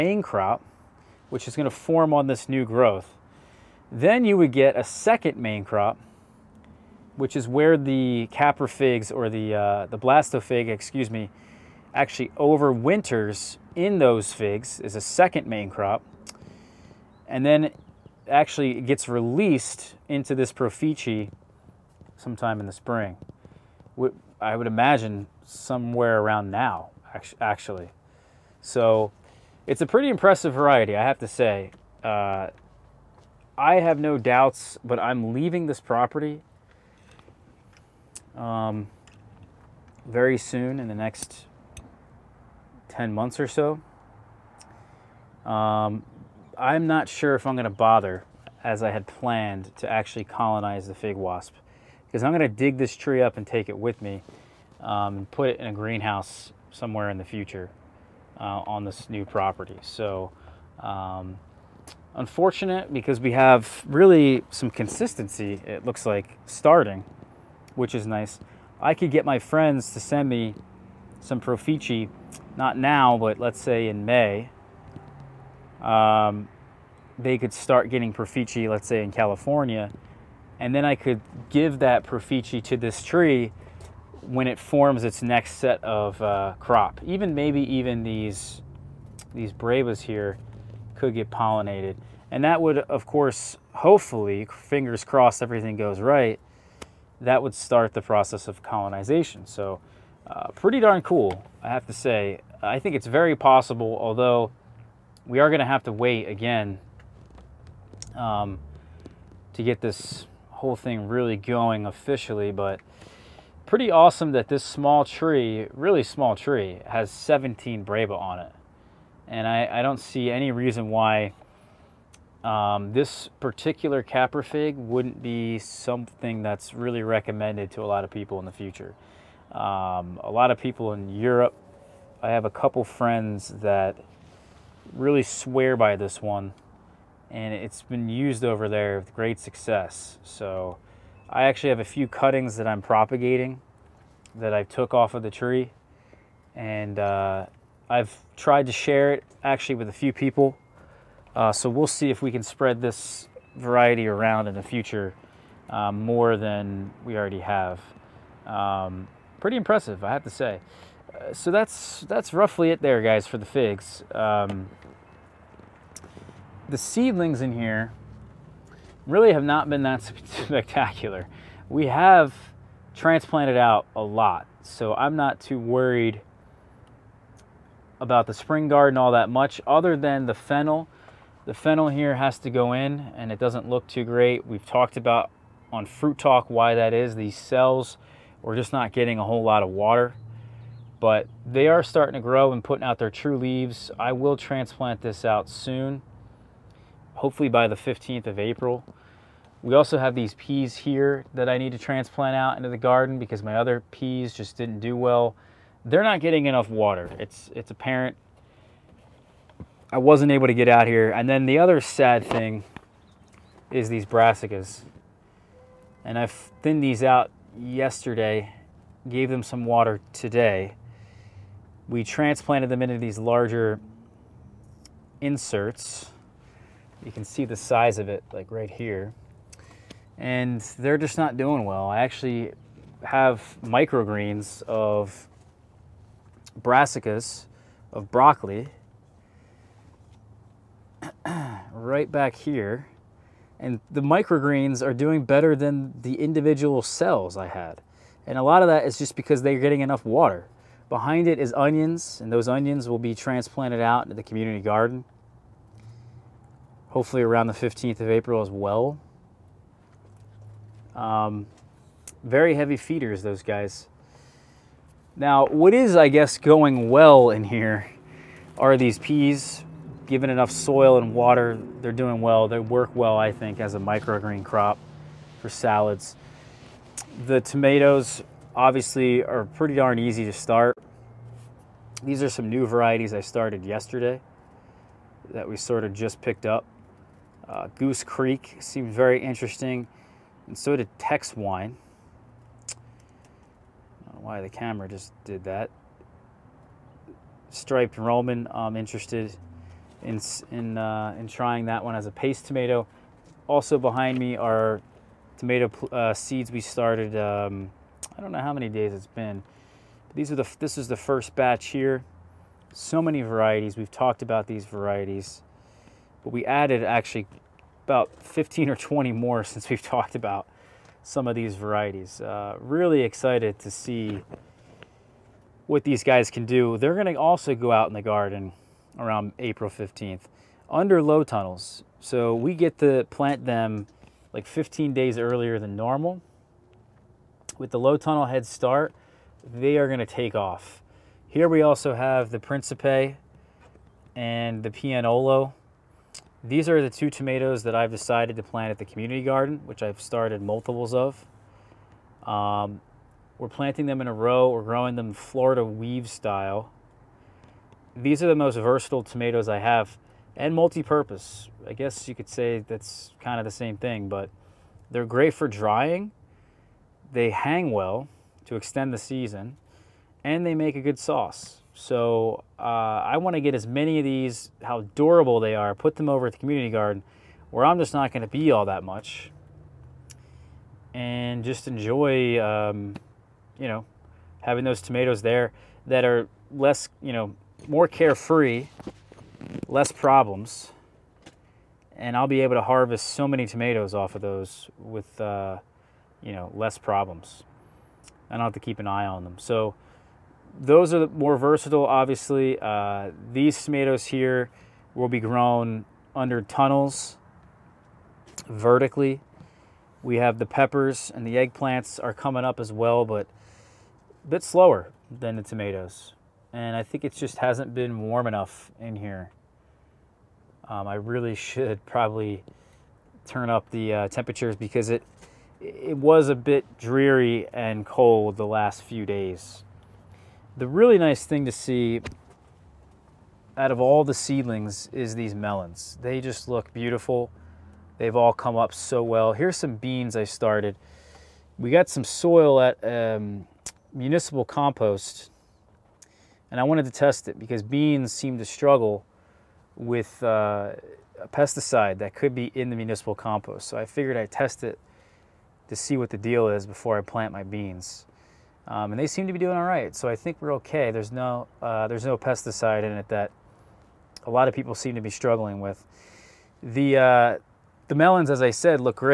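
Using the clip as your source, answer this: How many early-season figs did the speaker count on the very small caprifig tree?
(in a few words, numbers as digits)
17.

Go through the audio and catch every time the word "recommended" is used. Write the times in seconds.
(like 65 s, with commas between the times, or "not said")
127 s.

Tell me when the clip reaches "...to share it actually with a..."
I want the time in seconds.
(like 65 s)
148 s.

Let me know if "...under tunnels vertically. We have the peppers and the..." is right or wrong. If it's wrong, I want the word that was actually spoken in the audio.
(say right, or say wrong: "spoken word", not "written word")
right.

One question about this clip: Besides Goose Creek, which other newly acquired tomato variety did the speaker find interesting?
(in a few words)
Tex Wine.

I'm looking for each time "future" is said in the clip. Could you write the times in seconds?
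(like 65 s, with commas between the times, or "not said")
57 s, 128 s, 154 s.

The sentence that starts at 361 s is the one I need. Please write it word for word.
I guess you could say that's kind of the same thing, but they're great for drying.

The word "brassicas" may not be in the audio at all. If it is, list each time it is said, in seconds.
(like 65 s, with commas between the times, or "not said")
214 s, 236 s.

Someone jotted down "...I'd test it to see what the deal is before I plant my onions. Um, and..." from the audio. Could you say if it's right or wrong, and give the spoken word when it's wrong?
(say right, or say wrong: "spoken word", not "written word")
wrong: "beans", not "onions".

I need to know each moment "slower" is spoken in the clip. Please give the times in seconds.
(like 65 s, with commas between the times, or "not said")
414 s.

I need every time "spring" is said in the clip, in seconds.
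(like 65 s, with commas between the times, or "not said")
22 s, 178 s.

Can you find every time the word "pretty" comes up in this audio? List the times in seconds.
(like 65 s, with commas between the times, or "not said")
29 s, 100 s, 113 s, 159 s, 279 s.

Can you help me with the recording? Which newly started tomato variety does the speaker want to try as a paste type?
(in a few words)
Striped Roman.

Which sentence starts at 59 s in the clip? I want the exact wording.
So, um, unfortunate because we have really some consistency, it looks like, starting which is nice.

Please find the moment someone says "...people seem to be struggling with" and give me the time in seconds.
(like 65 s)
464 s.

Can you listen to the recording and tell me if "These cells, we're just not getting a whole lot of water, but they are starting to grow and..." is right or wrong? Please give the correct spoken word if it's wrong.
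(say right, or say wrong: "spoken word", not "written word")
right.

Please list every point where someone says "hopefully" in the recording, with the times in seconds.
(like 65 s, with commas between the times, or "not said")
93 s, 197 s, 256 s.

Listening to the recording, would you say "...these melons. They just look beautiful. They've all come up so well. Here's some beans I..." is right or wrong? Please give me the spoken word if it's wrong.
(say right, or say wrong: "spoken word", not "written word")
right.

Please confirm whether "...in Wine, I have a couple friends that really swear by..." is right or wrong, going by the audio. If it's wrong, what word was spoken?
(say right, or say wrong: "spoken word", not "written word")
wrong: "Europe", not "Wine".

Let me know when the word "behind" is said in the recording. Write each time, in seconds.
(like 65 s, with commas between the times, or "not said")
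250 s, 303 s.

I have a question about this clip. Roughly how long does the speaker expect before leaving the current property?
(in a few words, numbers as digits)
10 months.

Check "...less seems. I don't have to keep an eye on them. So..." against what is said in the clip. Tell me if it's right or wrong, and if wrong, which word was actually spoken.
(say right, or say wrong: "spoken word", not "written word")
wrong: "problems", not "seems".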